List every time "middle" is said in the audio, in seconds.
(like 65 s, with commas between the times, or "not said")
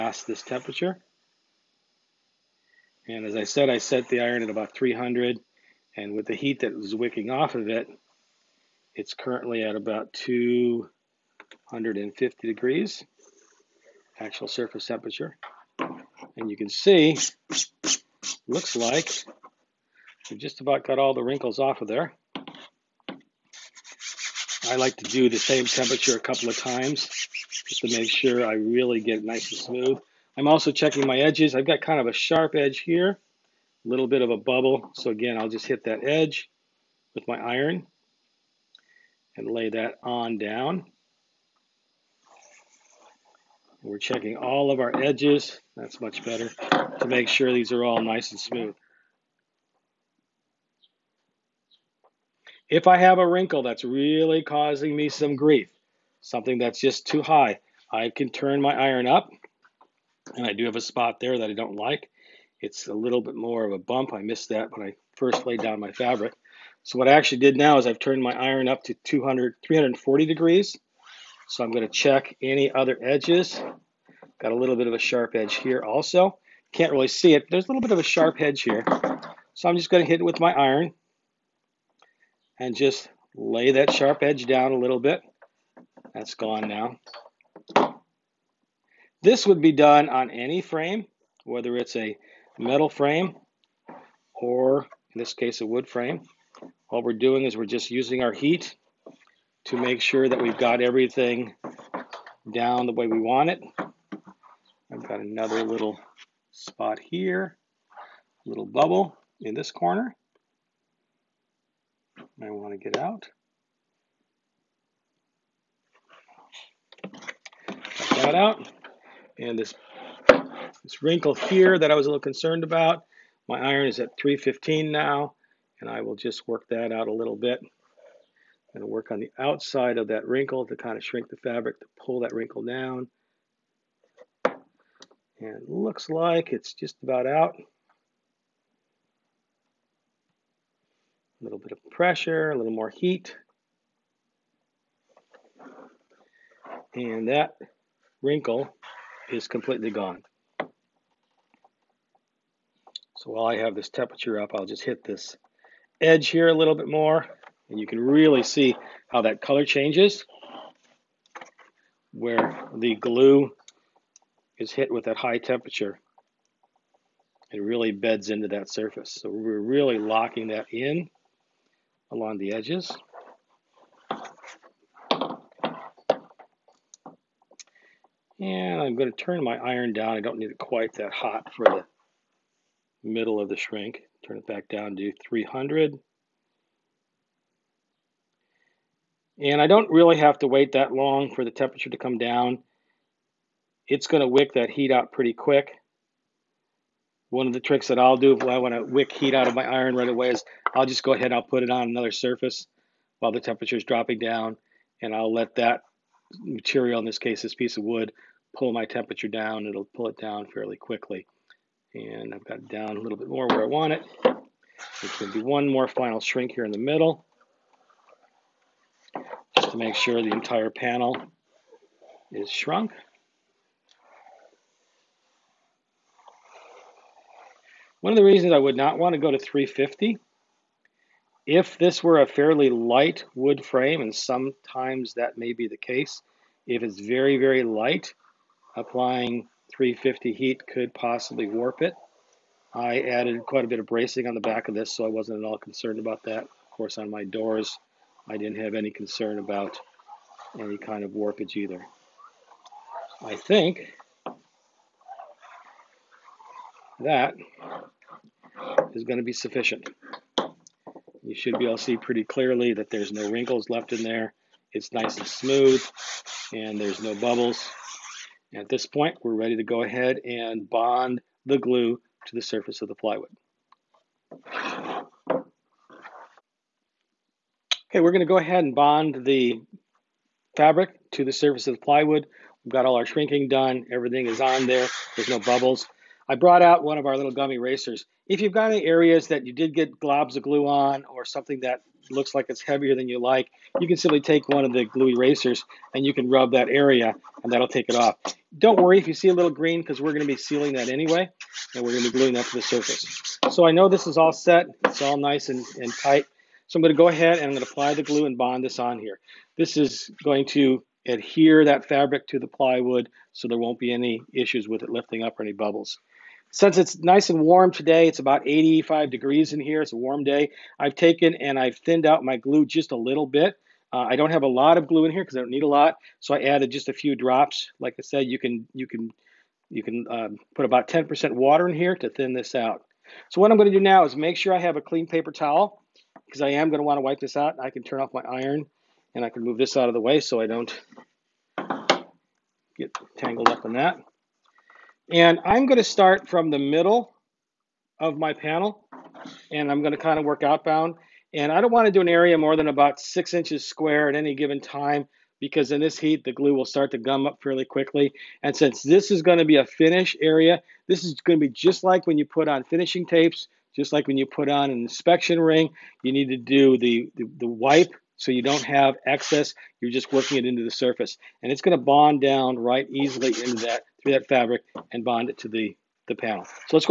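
183 s, 216 s, 346 s.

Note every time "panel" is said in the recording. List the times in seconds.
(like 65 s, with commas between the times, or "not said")
220 s, 348 s, 376 s.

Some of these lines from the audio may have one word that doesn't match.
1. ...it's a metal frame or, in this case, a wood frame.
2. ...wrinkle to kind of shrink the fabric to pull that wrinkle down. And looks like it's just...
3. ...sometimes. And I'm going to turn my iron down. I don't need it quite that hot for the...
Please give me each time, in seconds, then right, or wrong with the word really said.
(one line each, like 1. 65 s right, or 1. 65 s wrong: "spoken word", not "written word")
1. 91 s right
2. 130 s right
3. 172 s wrong: "edges", not "sometimes".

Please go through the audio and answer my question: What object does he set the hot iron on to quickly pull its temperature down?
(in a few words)
piece of wood.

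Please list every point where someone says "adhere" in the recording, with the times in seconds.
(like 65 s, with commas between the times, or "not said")
311 s.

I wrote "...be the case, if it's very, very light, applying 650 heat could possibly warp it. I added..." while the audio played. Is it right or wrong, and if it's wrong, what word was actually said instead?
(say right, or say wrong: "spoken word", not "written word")
wrong: "350", not "650".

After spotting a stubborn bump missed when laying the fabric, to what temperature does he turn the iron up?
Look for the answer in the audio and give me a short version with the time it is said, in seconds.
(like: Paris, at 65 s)
340 degrees, at 69 s.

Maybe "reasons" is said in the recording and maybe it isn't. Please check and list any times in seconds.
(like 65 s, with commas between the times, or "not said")
228 s.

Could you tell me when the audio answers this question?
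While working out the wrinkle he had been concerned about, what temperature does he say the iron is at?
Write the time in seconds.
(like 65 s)
124 s.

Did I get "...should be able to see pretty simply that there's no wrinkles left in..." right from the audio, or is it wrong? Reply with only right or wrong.
wrong.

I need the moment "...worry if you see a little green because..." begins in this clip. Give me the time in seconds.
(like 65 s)
298 s.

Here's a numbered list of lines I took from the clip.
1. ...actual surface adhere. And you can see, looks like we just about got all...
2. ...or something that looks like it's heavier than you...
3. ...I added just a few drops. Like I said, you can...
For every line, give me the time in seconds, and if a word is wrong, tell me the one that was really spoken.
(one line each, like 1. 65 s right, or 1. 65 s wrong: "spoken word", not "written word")
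1. 14 s wrong: "temperature", not "adhere"
2. 291 s right
3. 326 s right.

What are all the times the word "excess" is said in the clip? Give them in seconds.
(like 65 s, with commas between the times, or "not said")
369 s.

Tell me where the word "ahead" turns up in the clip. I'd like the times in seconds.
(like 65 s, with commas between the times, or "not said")
201 s, 269 s, 278 s, 307 s.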